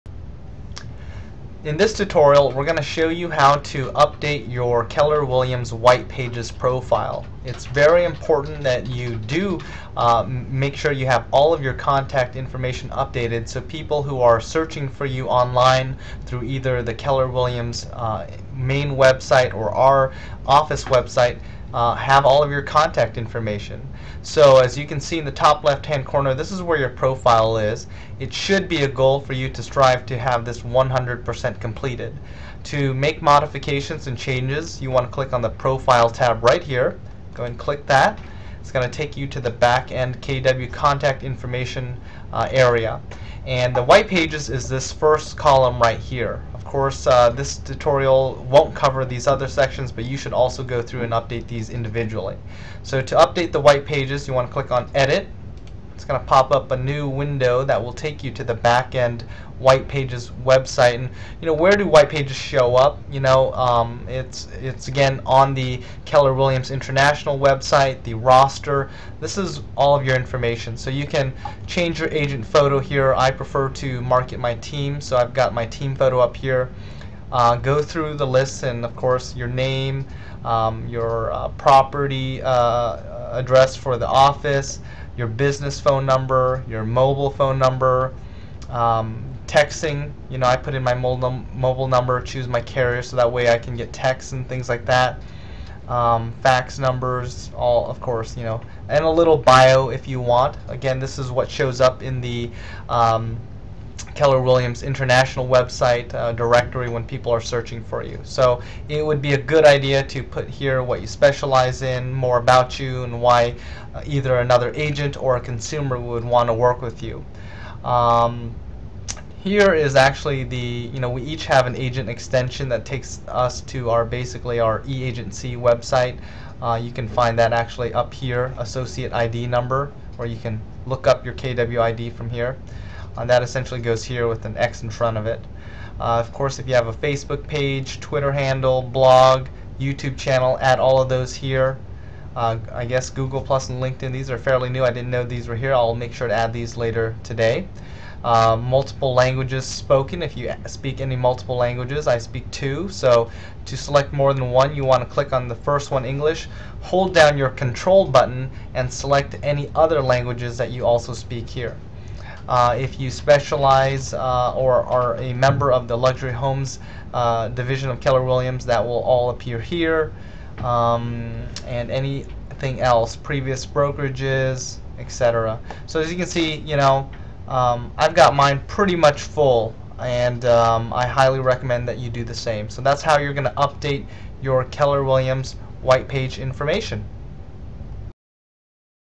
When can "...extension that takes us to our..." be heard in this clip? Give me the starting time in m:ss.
2:02.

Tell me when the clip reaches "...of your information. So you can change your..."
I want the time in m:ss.
1:09.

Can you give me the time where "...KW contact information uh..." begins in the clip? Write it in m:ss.
0:40.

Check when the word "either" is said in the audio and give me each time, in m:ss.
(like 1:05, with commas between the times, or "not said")
0:16, 1:54.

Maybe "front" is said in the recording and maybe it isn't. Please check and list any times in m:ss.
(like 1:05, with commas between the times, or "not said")
2:14.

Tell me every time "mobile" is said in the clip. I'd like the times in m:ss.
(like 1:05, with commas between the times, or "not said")
1:26, 1:30.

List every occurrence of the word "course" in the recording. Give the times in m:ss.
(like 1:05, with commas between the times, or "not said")
0:46, 1:18, 1:38, 2:16.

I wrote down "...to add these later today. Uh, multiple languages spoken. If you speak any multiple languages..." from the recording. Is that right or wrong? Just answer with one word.
right.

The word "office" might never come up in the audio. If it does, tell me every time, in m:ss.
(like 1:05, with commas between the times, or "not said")
0:20, 1:24.